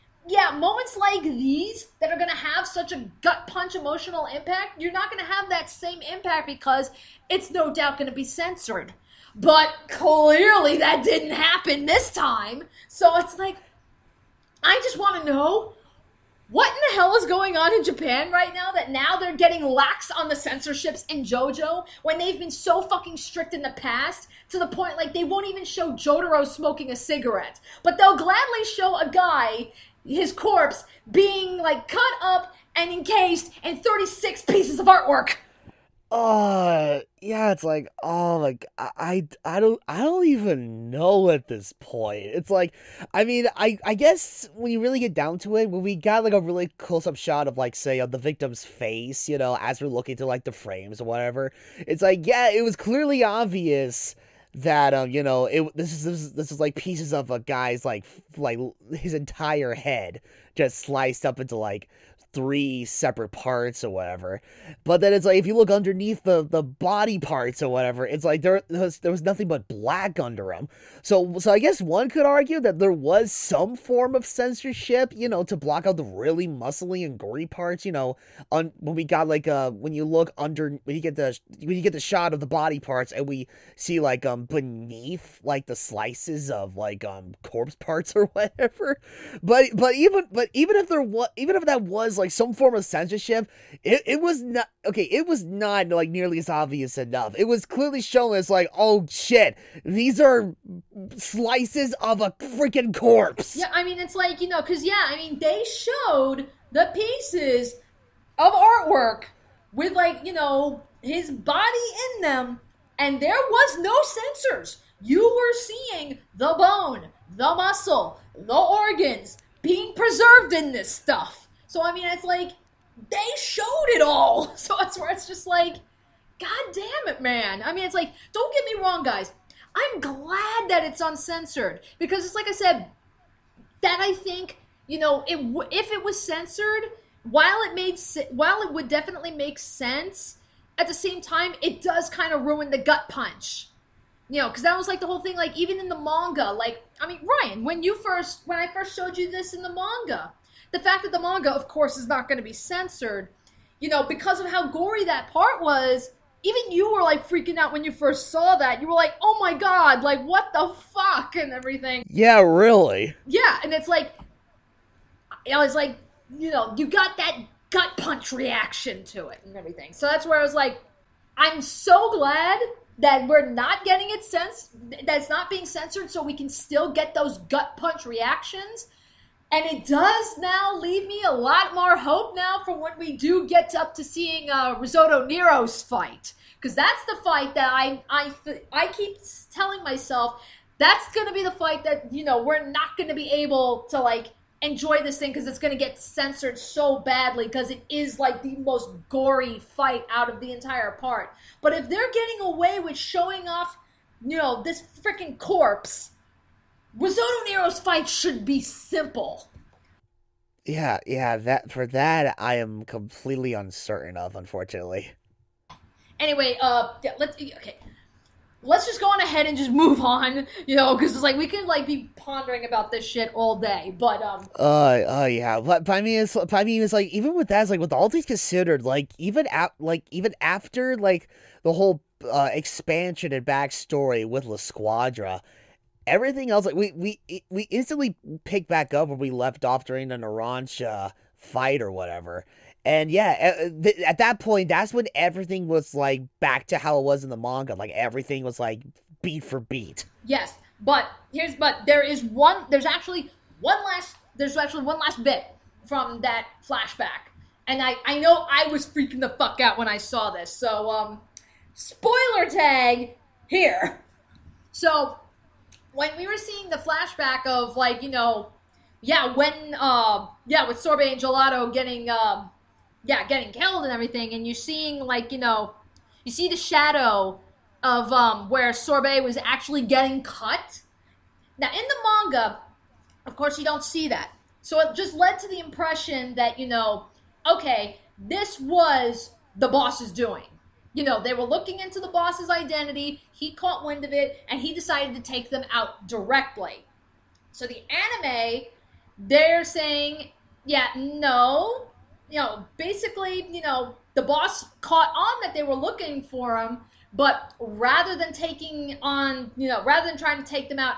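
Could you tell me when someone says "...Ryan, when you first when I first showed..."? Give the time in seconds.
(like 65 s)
147 s.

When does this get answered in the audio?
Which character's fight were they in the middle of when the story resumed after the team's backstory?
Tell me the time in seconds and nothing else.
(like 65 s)
240 s.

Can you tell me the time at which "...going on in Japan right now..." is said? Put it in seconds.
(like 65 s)
17 s.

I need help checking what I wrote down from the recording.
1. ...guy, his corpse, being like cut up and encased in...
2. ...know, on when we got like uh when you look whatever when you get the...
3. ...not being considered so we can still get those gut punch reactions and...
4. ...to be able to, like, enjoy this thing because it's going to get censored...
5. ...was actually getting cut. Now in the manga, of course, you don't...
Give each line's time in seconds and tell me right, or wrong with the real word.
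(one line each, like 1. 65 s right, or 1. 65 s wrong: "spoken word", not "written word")
1. 29 s right
2. 77 s wrong: "under", not "whatever"
3. 175 s wrong: "censored", not "considered"
4. 193 s right
5. 279 s right.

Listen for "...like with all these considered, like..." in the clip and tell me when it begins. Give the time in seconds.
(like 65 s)
227 s.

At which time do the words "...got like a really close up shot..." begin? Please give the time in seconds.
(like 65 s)
45 s.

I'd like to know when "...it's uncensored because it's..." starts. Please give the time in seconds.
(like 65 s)
130 s.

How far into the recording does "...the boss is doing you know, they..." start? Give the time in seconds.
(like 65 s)
289 s.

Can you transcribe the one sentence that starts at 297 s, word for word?
So the anime, they're saying, yeah, no.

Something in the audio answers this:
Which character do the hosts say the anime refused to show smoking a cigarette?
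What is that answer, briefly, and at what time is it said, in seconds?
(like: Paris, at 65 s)
Jotaro, at 25 s.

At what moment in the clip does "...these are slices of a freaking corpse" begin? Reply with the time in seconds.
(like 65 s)
99 s.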